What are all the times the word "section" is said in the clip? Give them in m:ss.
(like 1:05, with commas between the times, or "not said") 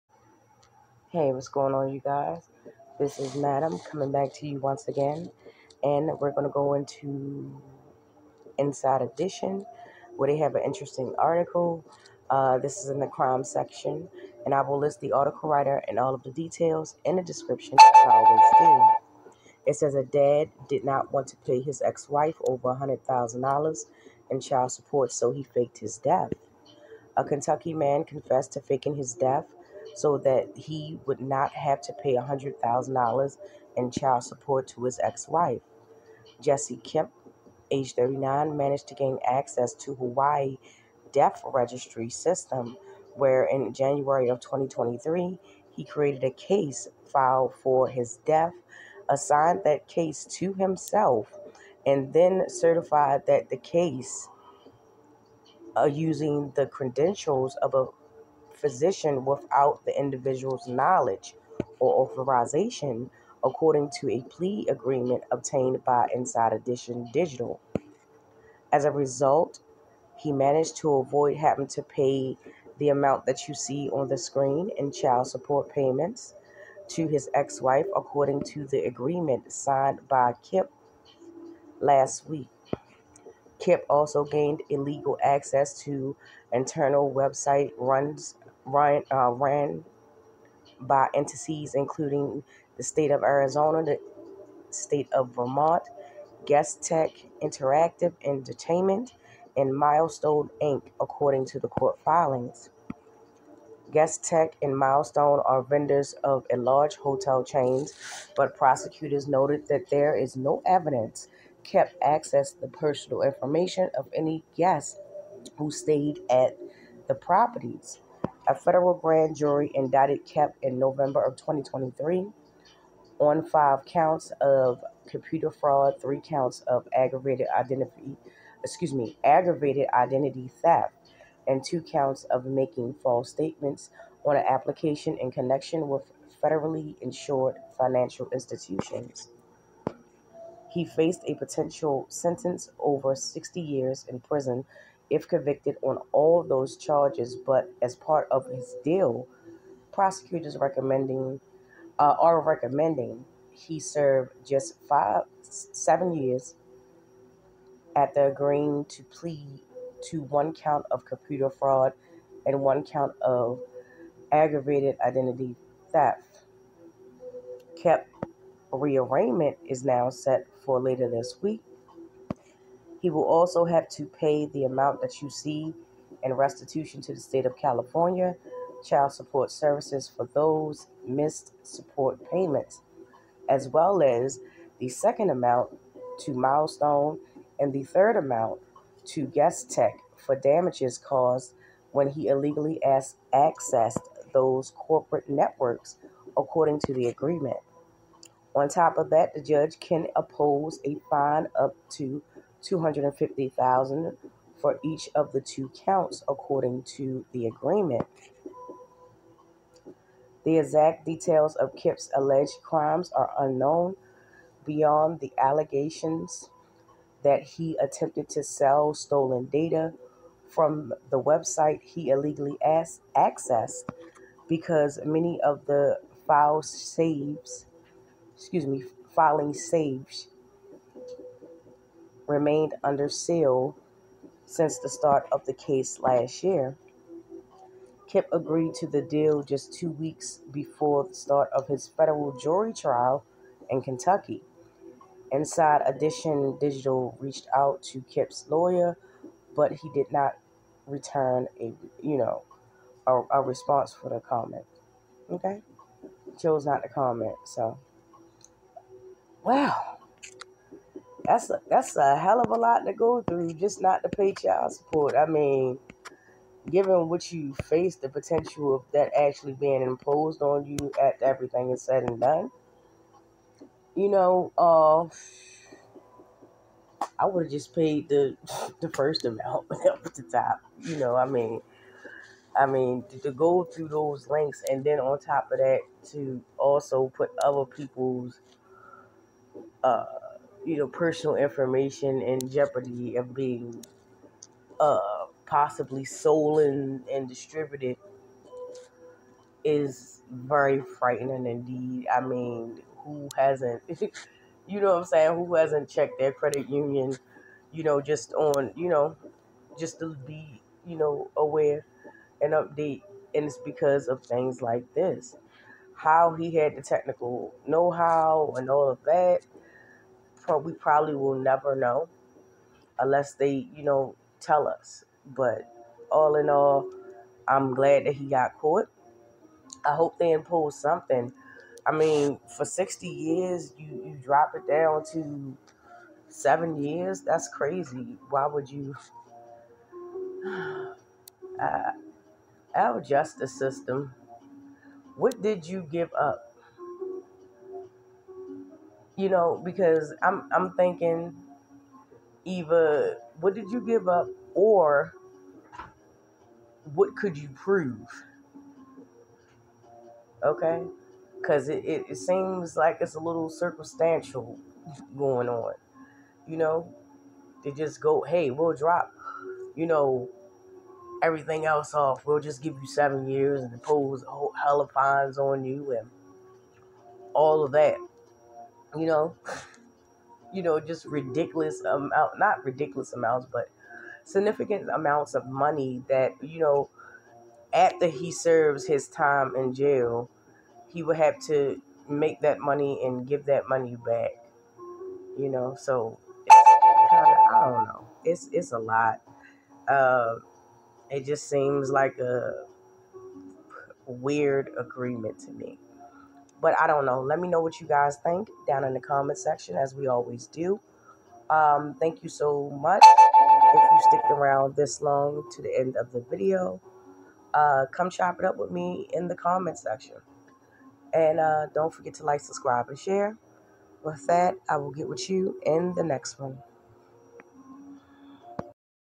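0:13, 6:49, 6:59.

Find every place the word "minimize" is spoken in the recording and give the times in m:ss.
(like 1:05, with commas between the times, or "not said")
not said.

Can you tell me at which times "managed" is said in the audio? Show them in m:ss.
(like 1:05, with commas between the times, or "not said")
0:38, 1:10.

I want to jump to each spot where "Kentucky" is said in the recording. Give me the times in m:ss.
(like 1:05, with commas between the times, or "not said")
0:27, 4:03.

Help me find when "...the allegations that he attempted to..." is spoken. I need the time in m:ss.
3:35.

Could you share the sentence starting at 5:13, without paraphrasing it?
And it's because of things like this.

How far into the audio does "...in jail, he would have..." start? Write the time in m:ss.
6:29.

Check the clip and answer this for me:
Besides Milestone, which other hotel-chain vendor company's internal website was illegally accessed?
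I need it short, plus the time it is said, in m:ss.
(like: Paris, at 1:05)
GuestTek Interactive Entertainment, at 1:36.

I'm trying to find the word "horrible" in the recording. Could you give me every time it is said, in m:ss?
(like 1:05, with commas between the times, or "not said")
not said.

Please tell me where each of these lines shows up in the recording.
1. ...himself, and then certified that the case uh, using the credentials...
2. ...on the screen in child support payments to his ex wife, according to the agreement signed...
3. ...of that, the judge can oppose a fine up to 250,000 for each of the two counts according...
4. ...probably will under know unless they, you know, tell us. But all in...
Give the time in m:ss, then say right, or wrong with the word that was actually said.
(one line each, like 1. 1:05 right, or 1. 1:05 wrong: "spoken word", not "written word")
1. 0:50 right
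2. 1:13 right
3. 3:18 right
4. 5:20 wrong: "never", not "under".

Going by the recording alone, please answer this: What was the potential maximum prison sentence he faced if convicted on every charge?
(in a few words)
over 60 years.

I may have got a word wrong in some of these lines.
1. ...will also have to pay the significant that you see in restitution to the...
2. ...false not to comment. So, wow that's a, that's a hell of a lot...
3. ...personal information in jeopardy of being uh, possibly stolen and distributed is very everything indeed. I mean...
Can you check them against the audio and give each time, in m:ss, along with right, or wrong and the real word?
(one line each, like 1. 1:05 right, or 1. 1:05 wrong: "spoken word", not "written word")
1. 2:53 wrong: "amount", not "significant"
2. 4:16 wrong: "chose", not "false"
3. 4:50 wrong: "frightening", not "everything".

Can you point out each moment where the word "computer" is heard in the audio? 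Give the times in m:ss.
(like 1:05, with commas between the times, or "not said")
2:05, 2:41.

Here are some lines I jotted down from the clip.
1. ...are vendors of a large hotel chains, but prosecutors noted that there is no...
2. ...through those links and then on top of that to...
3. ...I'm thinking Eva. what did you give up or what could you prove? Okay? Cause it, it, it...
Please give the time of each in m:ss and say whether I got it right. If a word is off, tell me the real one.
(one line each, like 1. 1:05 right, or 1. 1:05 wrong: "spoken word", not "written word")
1. 1:45 right
2. 4:43 right
3. 5:50 right.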